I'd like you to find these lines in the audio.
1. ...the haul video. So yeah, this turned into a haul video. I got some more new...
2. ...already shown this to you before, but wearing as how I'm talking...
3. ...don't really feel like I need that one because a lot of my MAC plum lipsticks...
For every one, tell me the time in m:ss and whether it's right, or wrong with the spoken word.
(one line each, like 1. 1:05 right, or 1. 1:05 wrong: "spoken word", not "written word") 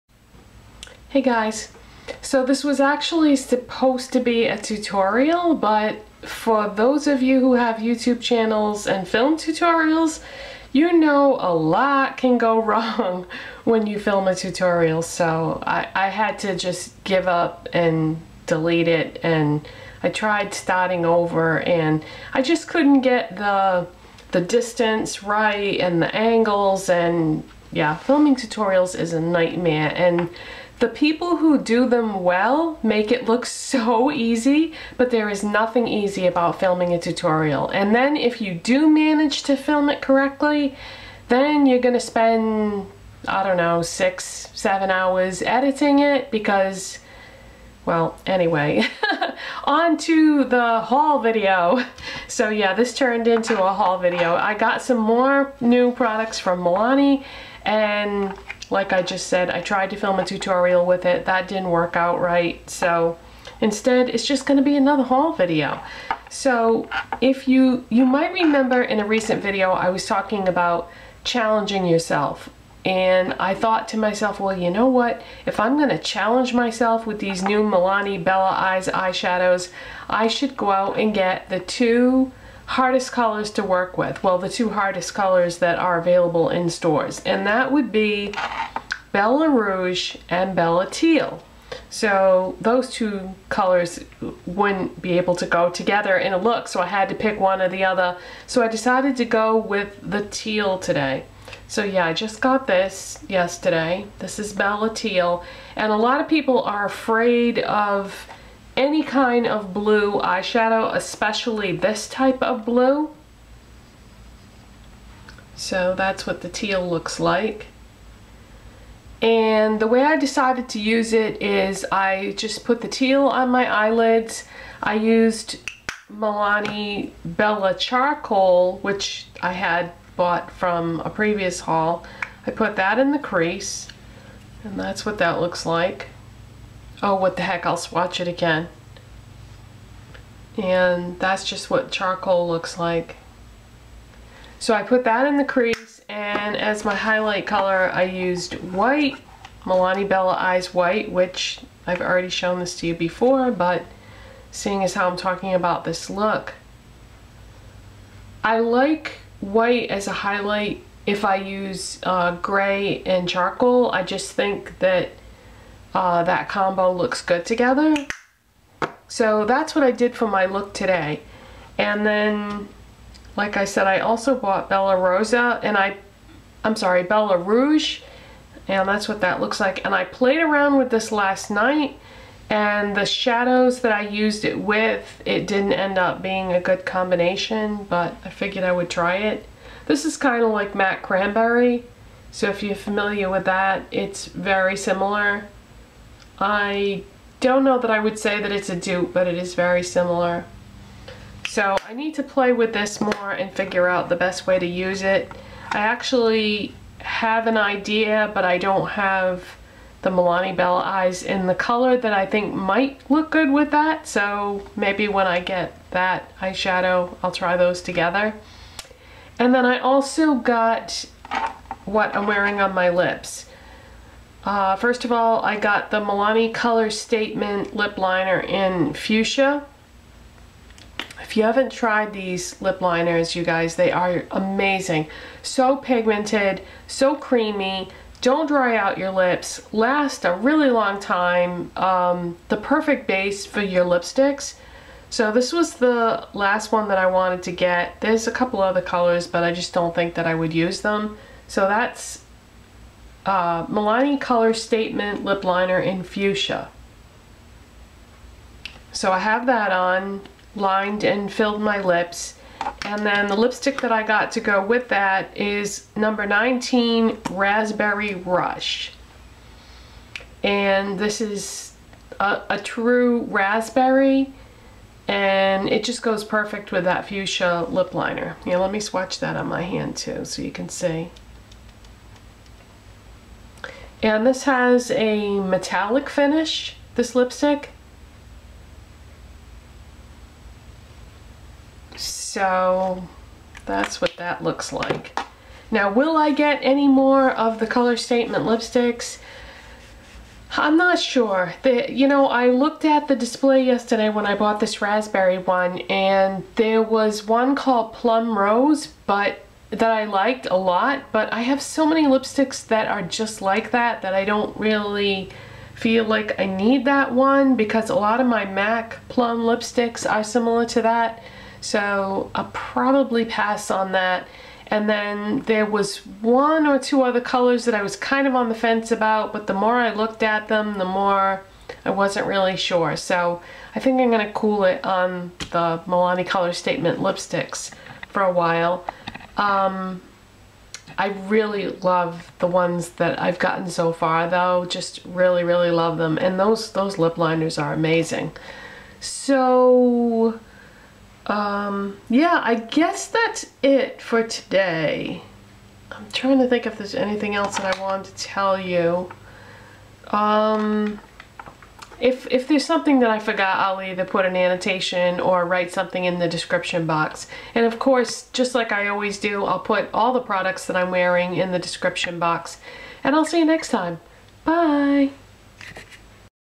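1. 0:50 right
2. 2:32 wrong: "seeing", not "wearing"
3. 5:14 right.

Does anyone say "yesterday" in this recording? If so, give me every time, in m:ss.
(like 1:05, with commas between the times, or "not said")
1:43, 5:03.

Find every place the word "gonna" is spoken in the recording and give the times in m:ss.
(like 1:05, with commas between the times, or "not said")
0:41, 5:34.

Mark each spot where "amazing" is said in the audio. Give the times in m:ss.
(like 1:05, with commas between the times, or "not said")
3:54, 5:47.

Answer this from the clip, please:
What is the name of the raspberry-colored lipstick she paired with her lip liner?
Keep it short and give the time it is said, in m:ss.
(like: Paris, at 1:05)
Raspberry Rush, at 4:27.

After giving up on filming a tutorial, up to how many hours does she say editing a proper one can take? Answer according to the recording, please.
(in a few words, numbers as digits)
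7.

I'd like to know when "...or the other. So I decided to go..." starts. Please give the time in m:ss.
1:37.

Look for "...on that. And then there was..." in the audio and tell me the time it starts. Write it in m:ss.
5:23.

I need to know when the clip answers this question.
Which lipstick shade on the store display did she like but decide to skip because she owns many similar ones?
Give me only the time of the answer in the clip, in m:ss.
5:07.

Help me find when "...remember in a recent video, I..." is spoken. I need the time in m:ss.
1:08.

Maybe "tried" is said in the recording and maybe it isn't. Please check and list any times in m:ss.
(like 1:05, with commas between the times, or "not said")
0:20, 0:59, 3:51.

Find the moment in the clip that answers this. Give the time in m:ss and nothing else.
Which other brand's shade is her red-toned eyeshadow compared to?
3:10.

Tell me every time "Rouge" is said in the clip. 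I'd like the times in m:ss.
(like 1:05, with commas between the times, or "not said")
1:29, 2:57.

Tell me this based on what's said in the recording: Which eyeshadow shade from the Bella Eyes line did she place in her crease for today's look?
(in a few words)
Bella Charcoal.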